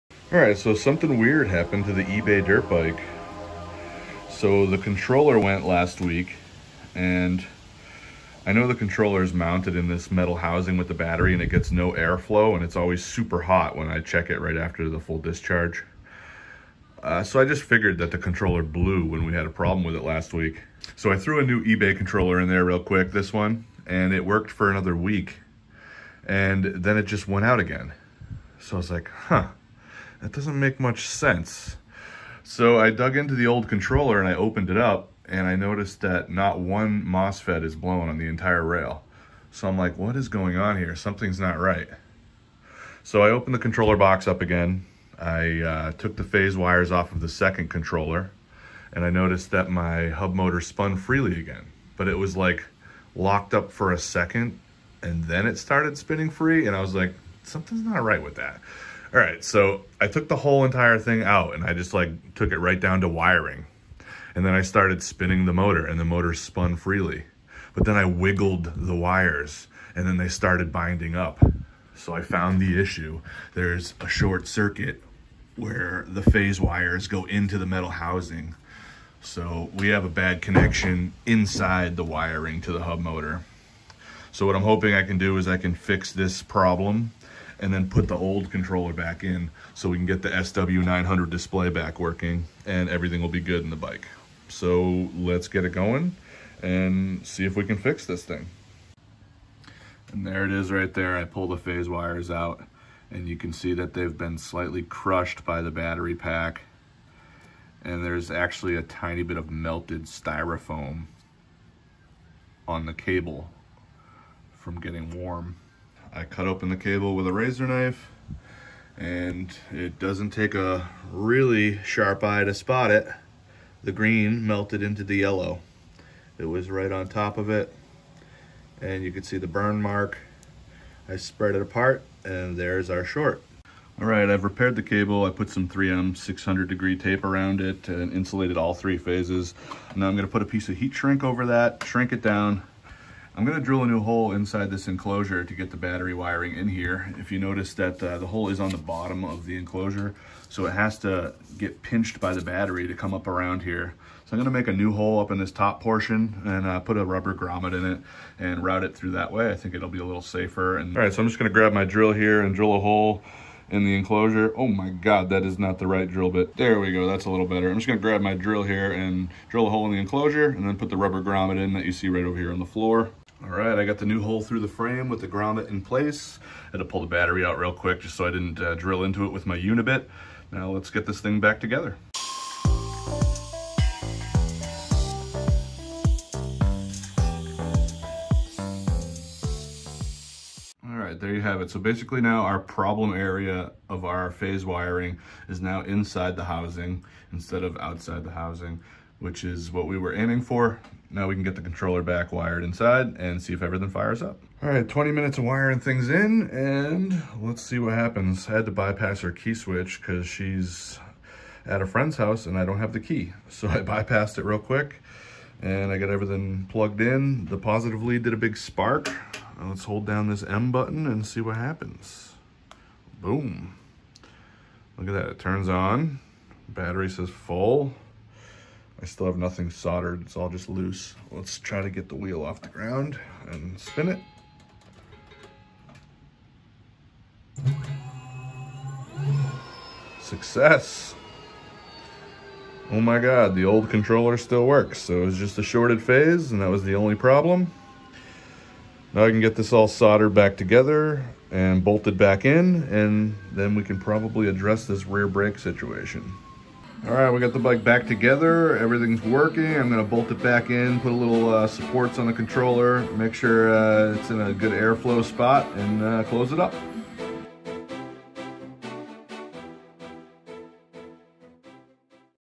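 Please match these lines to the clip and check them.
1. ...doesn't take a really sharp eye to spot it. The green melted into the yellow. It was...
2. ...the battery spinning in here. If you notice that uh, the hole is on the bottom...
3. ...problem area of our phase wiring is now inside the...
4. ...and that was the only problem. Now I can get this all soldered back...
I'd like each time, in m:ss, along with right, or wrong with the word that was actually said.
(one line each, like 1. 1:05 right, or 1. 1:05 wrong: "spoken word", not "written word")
1. 1:59 right
2. 2:25 wrong: "wiring", not "spinning"
3. 3:12 right
4. 4:06 right.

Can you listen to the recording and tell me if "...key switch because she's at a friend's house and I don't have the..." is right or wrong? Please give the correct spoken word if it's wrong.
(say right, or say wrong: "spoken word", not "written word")
right.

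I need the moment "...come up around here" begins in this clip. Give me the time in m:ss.
2:32.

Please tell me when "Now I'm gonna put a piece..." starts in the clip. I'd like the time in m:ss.
2:19.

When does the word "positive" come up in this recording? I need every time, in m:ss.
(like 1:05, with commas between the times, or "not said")
3:37.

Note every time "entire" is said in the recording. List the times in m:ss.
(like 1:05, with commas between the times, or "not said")
0:38, 1:00.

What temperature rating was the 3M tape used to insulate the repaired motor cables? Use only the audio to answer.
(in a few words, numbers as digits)
600 degree.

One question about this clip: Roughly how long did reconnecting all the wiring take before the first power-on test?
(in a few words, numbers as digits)
20 minutes.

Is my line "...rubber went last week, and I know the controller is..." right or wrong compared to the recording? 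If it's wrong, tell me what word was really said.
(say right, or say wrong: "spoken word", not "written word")
wrong: "controller", not "rubber".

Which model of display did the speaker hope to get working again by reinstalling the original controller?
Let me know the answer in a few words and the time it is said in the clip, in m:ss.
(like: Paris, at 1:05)
SW900, at 1:30.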